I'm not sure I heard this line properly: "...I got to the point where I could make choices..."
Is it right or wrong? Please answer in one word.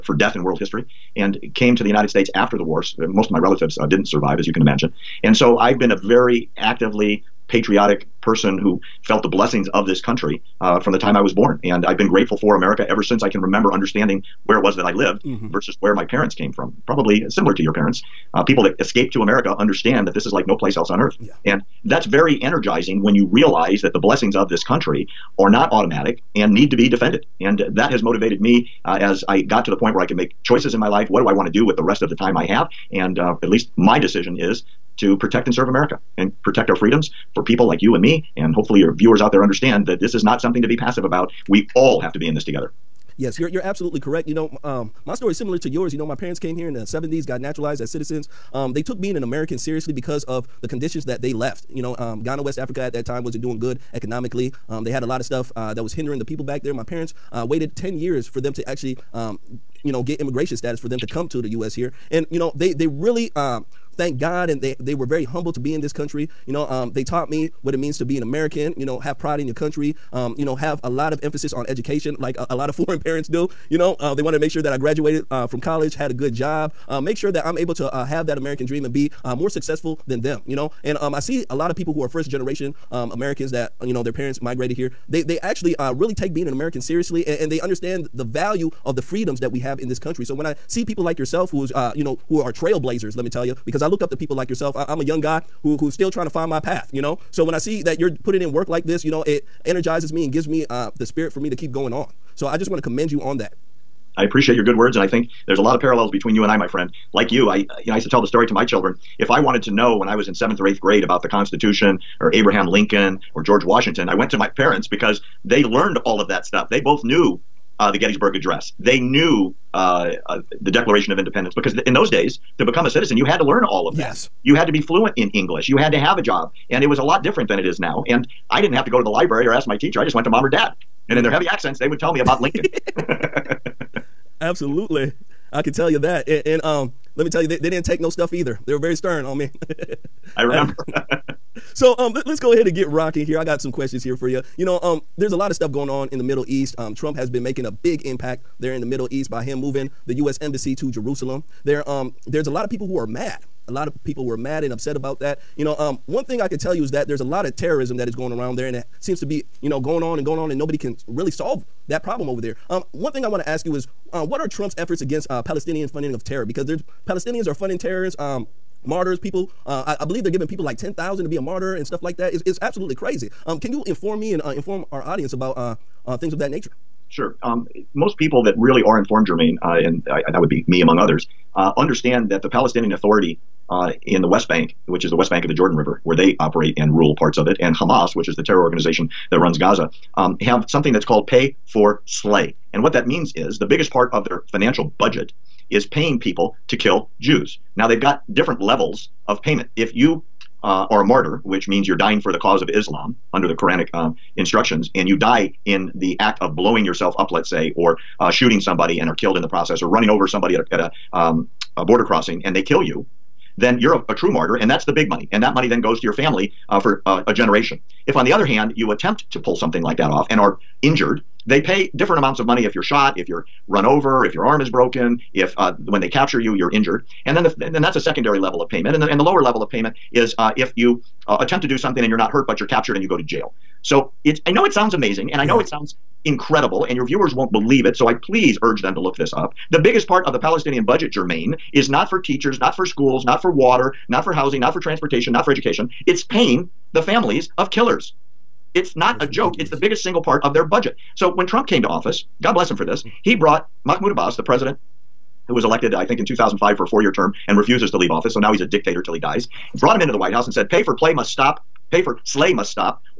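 right.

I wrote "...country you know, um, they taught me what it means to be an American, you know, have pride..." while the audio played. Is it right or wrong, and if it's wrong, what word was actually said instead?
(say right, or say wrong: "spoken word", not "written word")
right.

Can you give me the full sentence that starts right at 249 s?
It's the biggest single part of their budget.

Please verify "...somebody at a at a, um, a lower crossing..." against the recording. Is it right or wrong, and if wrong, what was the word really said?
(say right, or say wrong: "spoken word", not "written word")
wrong: "border", not "lower".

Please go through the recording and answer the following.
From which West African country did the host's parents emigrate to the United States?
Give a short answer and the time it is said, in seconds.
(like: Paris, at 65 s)
Ghana, at 52 s.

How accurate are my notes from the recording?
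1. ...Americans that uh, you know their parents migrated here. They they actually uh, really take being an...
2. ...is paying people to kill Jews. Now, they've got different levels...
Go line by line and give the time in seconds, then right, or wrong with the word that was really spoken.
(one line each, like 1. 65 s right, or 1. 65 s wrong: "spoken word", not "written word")
1. 83 s right
2. 195 s right.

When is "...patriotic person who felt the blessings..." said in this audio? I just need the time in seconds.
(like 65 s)
7 s.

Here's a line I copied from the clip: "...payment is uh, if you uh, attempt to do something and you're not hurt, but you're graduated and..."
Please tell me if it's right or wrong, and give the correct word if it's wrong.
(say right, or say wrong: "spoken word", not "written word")
wrong: "captured", not "graduated".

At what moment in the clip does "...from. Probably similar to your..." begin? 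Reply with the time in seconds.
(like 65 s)
16 s.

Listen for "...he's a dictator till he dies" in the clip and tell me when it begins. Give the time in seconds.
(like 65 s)
258 s.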